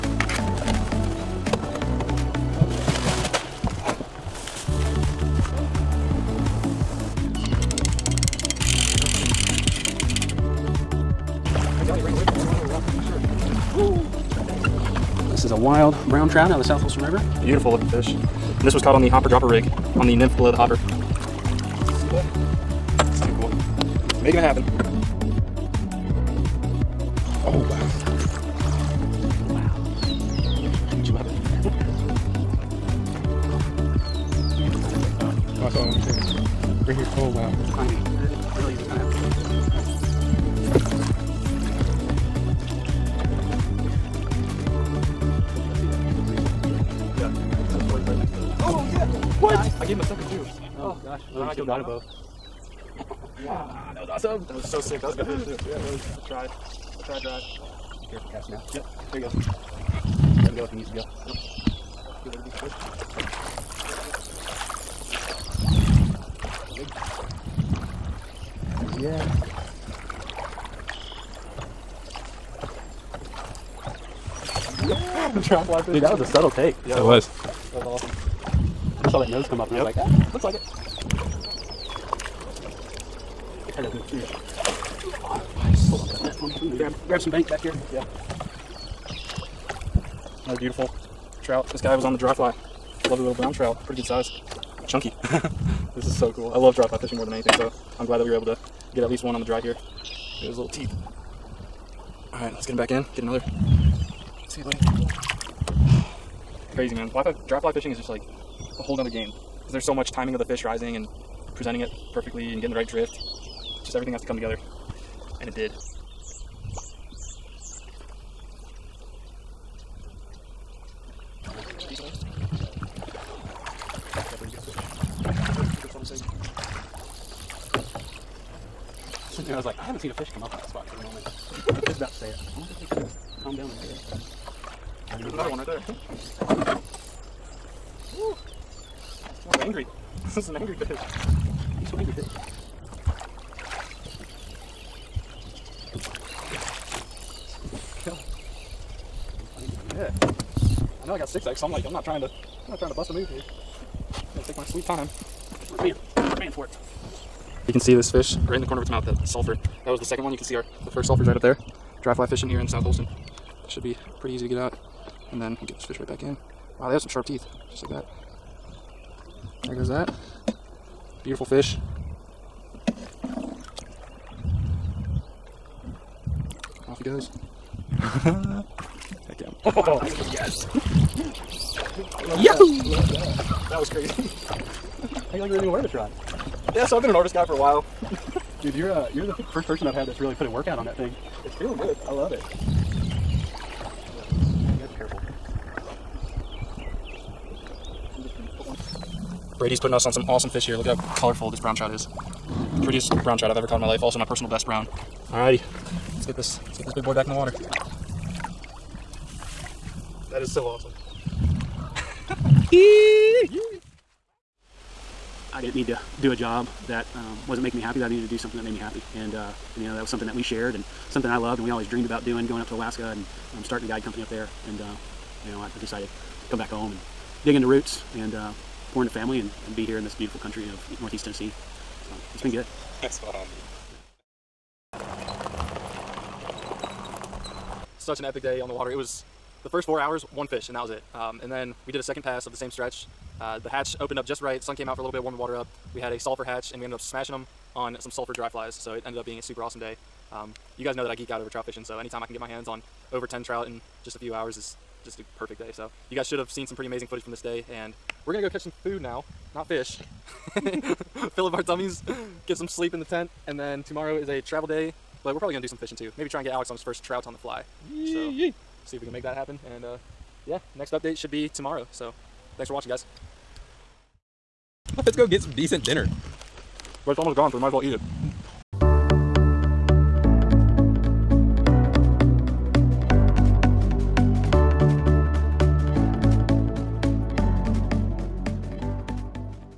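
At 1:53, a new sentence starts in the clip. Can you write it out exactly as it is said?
Just everything has to come together.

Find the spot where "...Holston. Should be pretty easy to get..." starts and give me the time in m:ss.
2:42.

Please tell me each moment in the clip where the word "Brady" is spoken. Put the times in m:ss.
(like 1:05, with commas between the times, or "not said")
3:19.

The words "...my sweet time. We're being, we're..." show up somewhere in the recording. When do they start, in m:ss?
2:34.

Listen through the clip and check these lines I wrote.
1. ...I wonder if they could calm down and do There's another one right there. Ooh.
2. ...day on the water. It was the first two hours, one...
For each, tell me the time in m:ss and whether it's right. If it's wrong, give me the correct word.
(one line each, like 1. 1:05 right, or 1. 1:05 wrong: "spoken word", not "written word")
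1. 2:12 right
2. 3:58 wrong: "four", not "two".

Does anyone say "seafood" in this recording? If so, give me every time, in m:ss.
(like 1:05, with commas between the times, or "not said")
not said.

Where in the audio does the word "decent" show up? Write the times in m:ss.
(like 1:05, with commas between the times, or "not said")
1:02, 4:35.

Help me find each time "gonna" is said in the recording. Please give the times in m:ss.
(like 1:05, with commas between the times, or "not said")
2:34, 4:18, 4:25.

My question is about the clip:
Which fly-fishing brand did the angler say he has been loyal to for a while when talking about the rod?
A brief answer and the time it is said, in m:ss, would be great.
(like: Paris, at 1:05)
Orvis, at 3:07.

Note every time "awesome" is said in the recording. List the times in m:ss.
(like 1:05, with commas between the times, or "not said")
0:54, 1:18, 3:20, 3:30, 4:09.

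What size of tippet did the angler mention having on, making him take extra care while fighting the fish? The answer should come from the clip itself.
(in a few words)
6X.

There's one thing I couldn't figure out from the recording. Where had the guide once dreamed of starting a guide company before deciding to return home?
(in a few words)
Alaska.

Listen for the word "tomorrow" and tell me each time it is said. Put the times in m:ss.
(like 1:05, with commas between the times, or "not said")
4:23, 4:31.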